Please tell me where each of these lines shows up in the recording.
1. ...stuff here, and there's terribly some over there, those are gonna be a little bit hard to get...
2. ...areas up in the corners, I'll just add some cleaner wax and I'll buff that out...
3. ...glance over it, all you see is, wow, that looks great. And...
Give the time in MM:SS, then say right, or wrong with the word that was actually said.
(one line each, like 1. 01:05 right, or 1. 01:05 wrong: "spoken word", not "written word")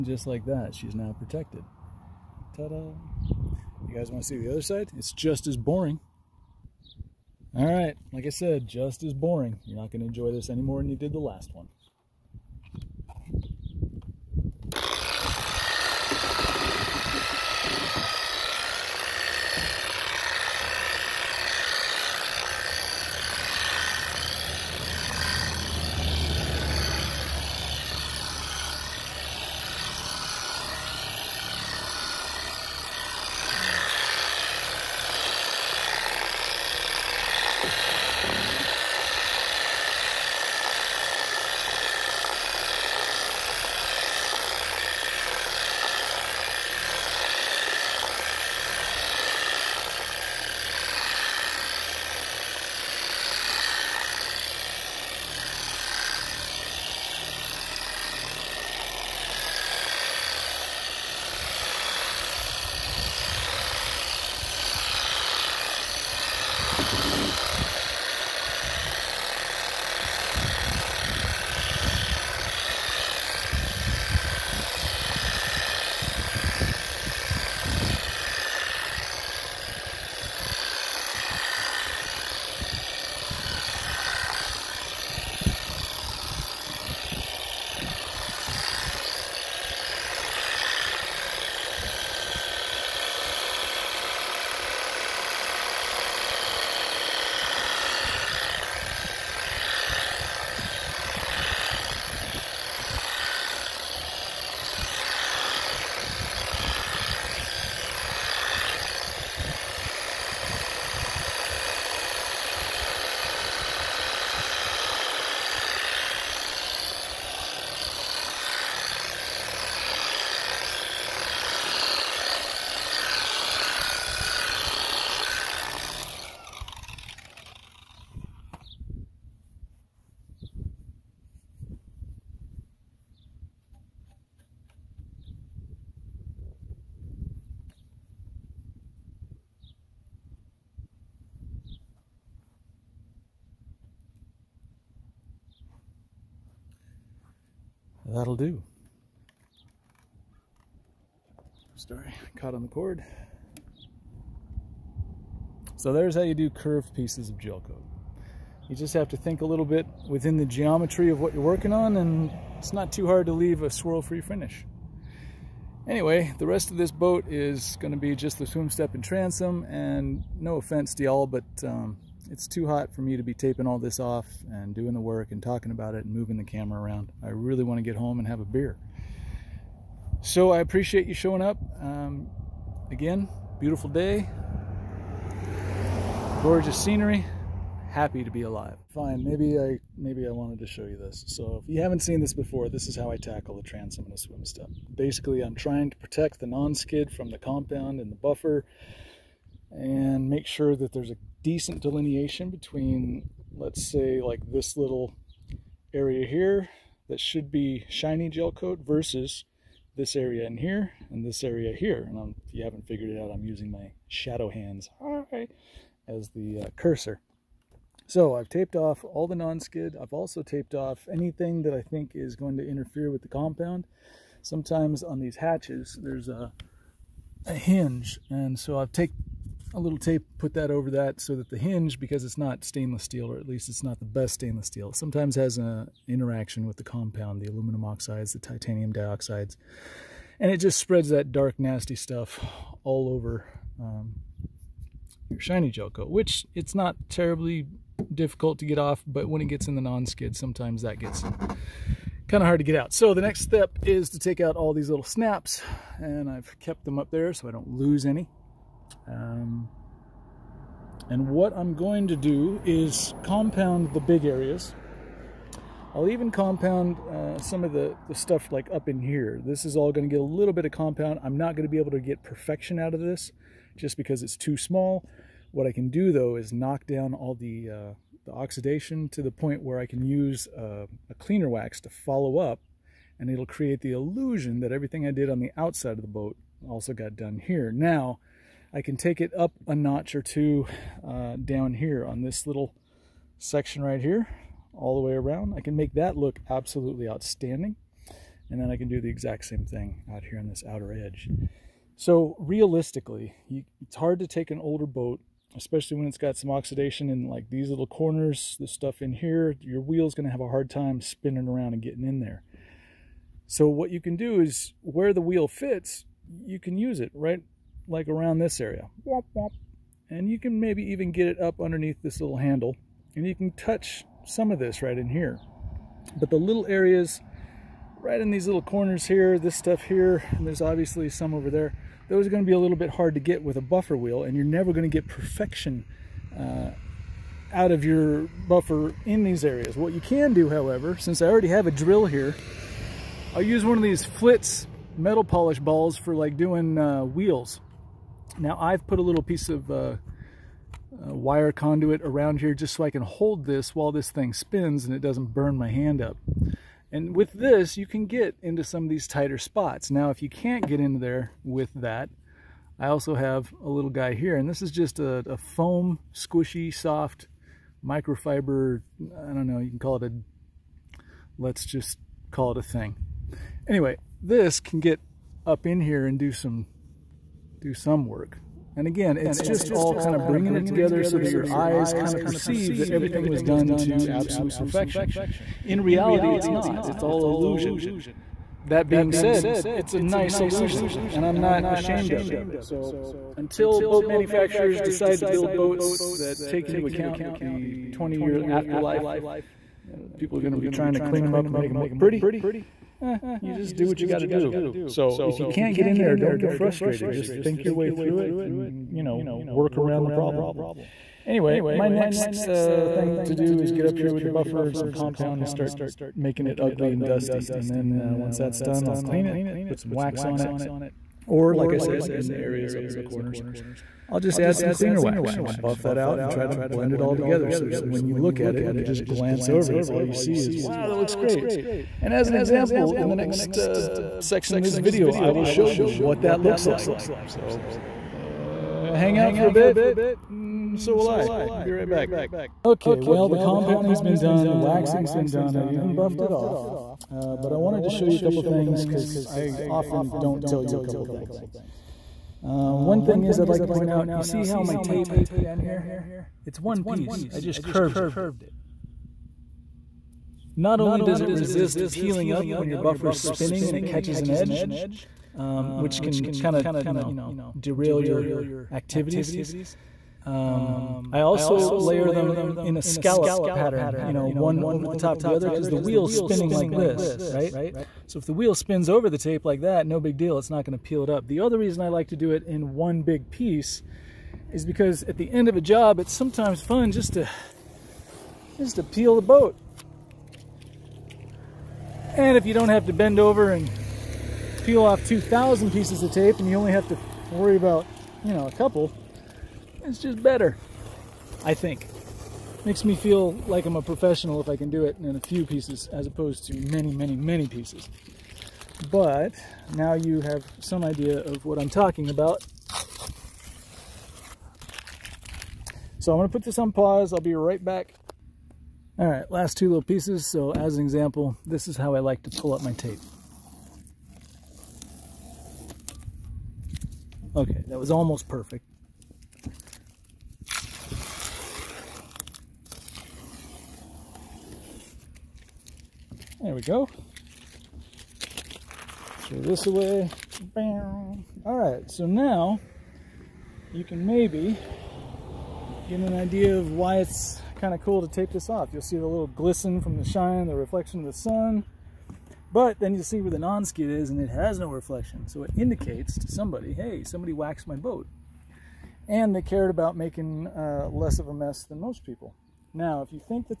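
1. 05:29 wrong: "obviously", not "terribly"
2. 07:02 right
3. 07:09 right.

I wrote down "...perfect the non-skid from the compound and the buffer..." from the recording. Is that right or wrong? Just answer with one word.
wrong.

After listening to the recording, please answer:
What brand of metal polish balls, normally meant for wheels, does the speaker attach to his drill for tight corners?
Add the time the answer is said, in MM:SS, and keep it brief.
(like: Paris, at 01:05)
Flitz, at 05:44.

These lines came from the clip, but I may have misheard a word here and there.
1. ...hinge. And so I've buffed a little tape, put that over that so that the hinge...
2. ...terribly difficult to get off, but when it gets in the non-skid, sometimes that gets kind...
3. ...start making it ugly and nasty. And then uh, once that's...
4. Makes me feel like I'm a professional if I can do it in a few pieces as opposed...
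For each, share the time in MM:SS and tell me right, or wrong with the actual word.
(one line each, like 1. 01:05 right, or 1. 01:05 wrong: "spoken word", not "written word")
1. 03:47 wrong: "taped", not "buffed"
2. 04:07 right
3. 06:55 wrong: "dusty", not "nasty"
4. 08:22 right.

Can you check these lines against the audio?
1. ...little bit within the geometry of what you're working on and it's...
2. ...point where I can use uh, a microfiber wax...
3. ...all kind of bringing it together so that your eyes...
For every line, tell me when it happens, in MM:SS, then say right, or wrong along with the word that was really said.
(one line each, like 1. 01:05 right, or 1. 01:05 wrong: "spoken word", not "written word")
1. 02:39 right
2. 04:39 wrong: "cleaner", not "microfiber"
3. 06:19 right.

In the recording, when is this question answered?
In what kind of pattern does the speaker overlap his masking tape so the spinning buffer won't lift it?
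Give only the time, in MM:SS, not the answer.
07:52.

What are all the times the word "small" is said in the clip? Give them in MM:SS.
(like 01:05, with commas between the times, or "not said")
04:34.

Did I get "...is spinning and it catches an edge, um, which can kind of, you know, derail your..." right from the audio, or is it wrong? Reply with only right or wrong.
right.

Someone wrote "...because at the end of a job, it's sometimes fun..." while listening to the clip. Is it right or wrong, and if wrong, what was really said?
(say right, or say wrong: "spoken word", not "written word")
right.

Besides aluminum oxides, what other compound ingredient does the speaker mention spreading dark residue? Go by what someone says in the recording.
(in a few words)
titanium dioxides.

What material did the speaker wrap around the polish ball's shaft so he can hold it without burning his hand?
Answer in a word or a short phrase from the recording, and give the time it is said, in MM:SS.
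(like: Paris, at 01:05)
wire conduit, at 05:51.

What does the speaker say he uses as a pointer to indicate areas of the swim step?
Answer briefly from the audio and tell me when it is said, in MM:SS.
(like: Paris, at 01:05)
shadow hands, at 03:34.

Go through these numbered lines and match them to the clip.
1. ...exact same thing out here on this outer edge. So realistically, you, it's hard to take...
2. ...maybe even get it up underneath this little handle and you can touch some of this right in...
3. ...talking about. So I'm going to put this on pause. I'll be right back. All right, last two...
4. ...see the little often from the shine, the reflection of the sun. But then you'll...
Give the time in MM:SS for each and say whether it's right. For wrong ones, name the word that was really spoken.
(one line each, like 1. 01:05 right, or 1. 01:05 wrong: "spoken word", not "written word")
1. 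04:59 right
2. 05:20 right
3. 08:31 right
4. 09:08 wrong: "glisten", not "often".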